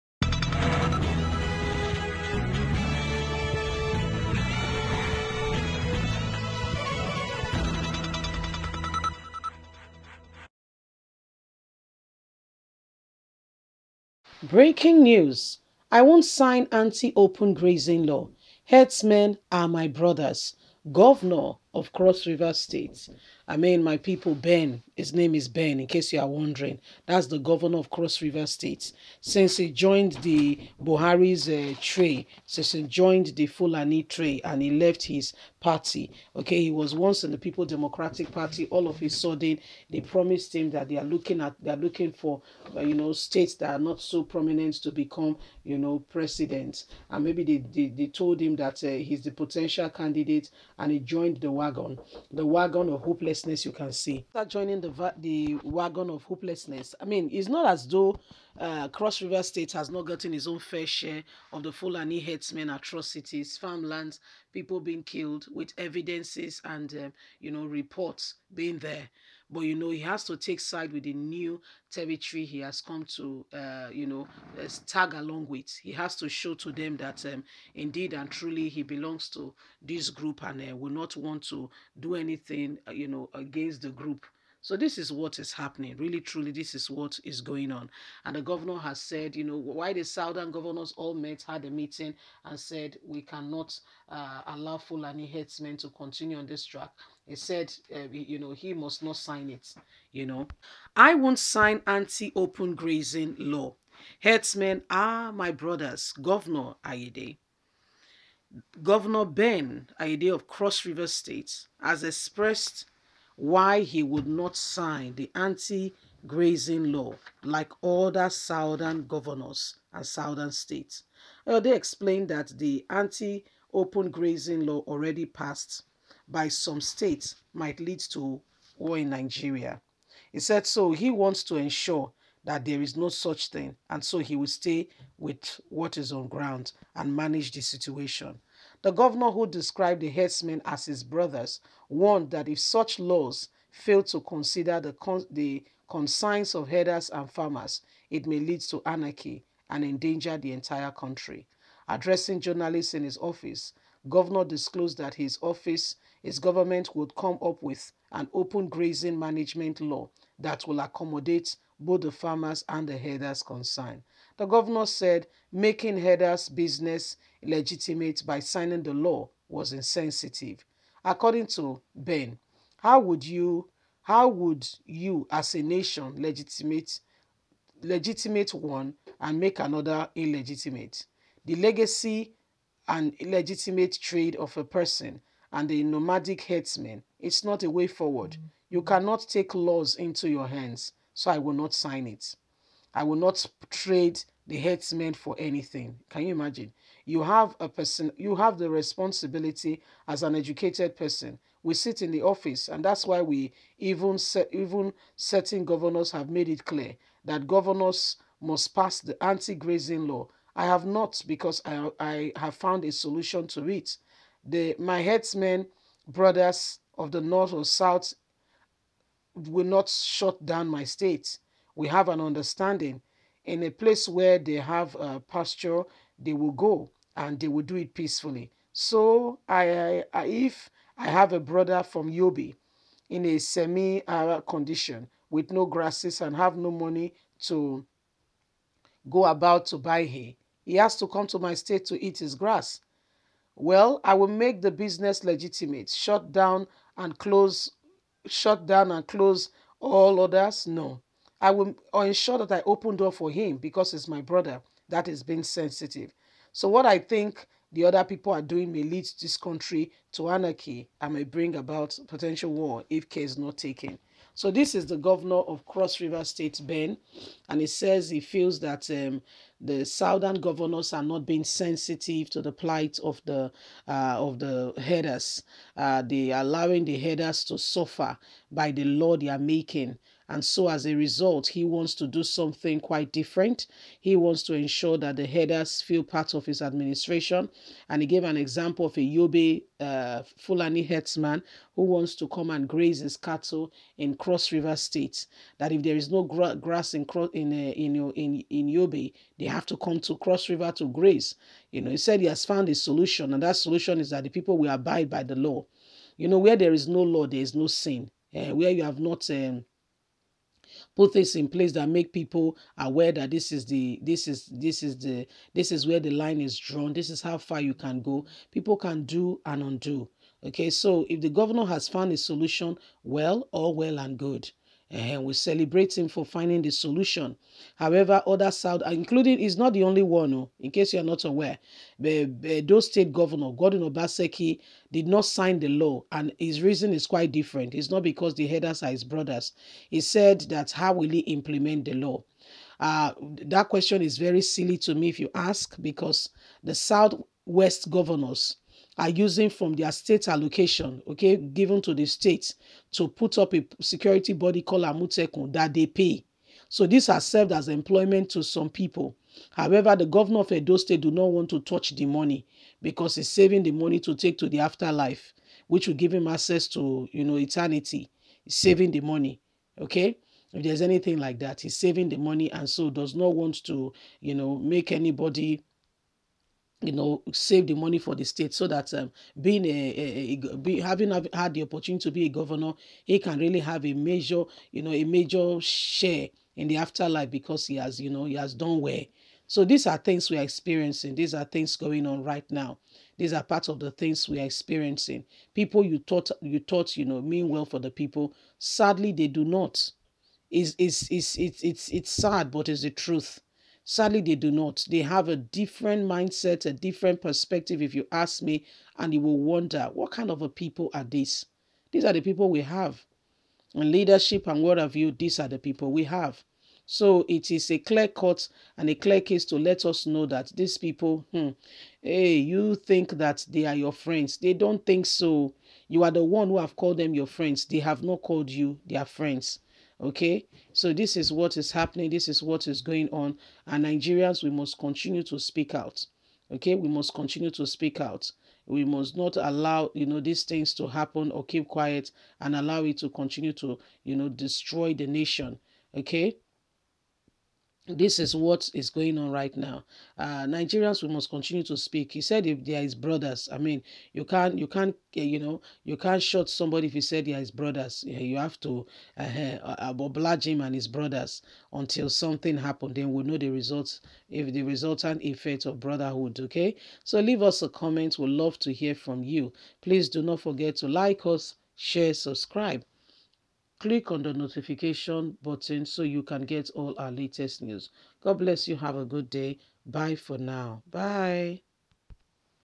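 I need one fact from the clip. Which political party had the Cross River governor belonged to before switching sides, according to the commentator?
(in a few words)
People's Democratic Party.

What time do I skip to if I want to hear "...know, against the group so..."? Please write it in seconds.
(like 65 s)
83 s.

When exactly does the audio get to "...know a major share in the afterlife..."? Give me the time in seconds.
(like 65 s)
384 s.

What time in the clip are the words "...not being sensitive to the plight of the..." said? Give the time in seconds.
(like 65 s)
271 s.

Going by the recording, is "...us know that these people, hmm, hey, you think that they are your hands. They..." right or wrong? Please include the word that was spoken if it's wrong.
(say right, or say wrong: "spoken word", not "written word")
wrong: "friends", not "hands".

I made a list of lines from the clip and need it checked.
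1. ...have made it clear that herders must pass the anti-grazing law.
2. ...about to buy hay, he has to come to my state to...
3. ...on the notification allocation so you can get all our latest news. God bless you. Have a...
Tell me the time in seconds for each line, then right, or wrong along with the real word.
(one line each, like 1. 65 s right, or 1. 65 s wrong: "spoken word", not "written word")
1. 206 s wrong: "governors", not "herders"
2. 239 s right
3. 474 s wrong: "button", not "allocation".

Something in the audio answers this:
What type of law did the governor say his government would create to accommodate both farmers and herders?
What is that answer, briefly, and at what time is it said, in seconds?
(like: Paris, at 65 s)
open grazing management law, at 158 s.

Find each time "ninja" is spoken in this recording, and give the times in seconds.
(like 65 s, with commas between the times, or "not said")
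not said.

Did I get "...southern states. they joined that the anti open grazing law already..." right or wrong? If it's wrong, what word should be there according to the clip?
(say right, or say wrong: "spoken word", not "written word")
wrong: "explained", not "joined".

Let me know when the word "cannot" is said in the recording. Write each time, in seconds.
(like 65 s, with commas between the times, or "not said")
93 s, 188 s.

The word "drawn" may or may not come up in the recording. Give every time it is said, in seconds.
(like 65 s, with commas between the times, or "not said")
316 s.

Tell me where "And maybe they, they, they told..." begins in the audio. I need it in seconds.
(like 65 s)
47 s.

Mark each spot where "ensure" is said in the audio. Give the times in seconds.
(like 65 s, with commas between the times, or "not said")
131 s, 251 s, 284 s.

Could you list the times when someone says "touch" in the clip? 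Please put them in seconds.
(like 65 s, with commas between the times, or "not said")
361 s.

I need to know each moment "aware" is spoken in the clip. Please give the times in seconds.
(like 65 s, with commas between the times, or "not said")
312 s, 331 s.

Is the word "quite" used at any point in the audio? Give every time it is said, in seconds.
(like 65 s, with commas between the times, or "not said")
282 s, 337 s.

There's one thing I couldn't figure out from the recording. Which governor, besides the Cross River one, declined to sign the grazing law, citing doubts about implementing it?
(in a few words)
Godwin Obaseki.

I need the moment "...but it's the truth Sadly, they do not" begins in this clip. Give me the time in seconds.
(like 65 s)
402 s.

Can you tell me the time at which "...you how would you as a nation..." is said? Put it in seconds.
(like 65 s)
173 s.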